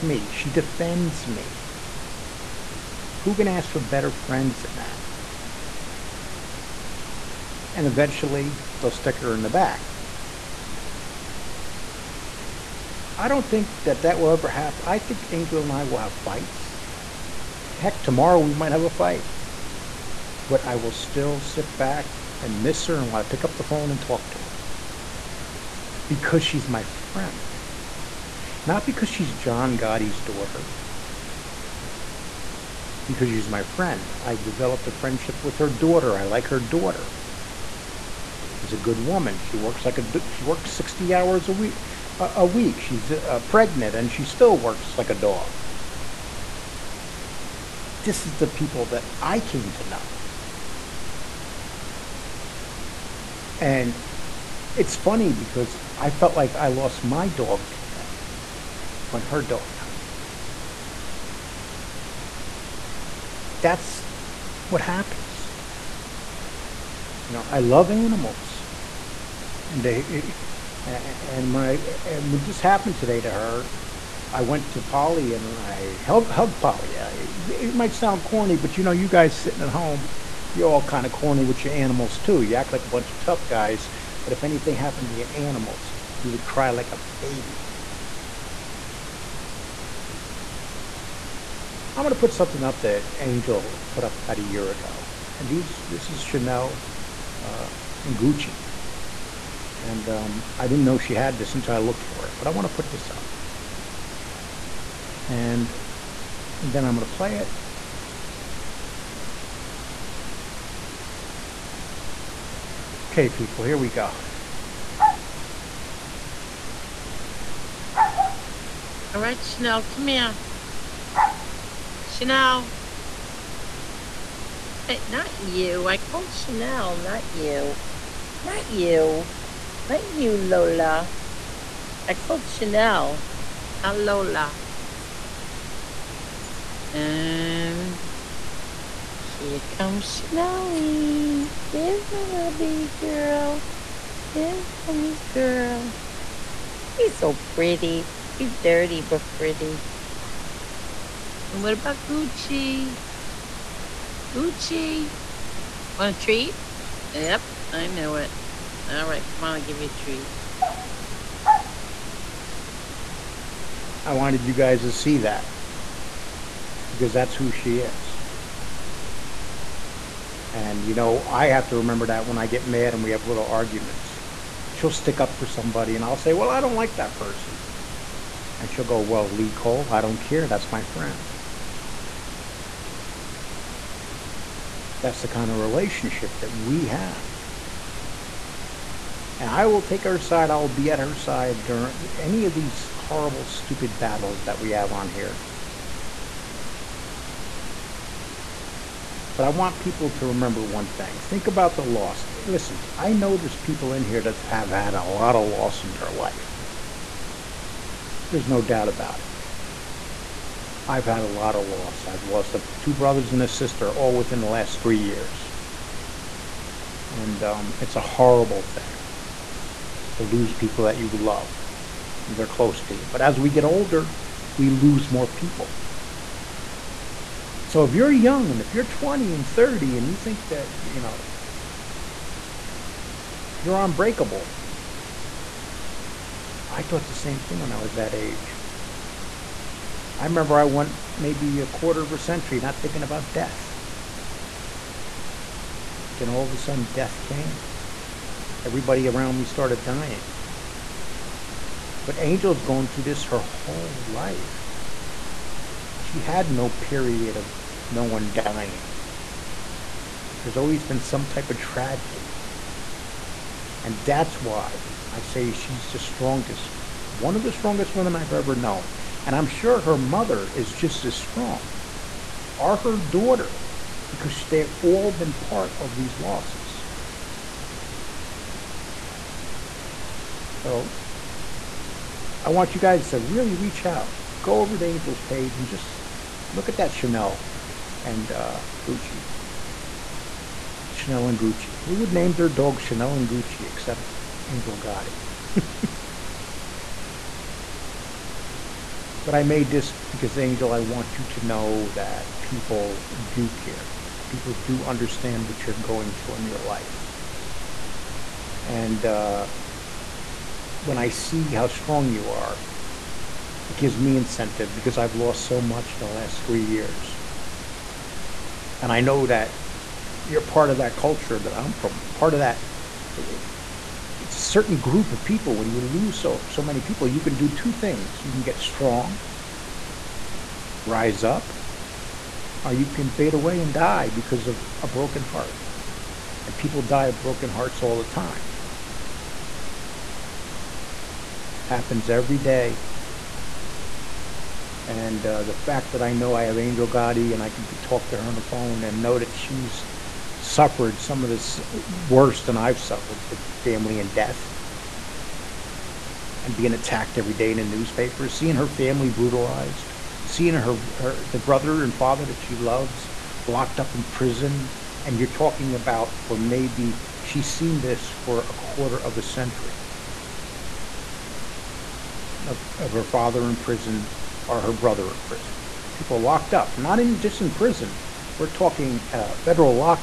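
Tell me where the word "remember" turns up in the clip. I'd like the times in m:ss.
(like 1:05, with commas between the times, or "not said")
2:51, 3:20, 4:00.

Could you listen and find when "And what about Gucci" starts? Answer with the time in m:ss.
2:31.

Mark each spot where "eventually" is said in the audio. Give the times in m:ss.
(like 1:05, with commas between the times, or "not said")
0:07.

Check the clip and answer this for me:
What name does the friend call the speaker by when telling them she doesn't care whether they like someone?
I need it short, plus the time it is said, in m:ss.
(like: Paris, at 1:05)
Lee Cole, at 2:59.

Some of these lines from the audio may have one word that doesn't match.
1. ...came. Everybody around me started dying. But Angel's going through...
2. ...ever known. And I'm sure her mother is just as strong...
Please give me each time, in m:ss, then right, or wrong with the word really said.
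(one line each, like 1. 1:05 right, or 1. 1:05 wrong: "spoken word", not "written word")
1. 4:07 right
2. 4:28 right.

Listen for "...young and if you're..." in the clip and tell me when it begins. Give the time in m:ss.
3:48.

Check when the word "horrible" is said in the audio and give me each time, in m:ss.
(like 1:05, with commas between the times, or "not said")
3:12, 3:38.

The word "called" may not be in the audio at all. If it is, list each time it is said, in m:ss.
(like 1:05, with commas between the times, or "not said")
2:05, 2:12.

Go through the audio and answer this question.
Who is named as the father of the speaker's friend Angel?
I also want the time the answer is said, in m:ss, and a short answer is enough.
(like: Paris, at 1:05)
John Gotti, at 0:29.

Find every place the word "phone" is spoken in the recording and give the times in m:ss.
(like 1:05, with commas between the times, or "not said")
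0:23, 5:48.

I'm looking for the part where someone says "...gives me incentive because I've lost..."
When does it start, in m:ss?
5:13.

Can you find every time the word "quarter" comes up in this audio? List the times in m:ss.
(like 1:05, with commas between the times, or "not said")
4:01, 6:08.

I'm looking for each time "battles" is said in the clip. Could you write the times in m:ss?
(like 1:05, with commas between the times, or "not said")
3:13.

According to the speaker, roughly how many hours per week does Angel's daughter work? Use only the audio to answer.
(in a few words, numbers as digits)
60.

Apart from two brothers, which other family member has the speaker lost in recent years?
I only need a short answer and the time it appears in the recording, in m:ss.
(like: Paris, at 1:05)
A sister, at 3:33.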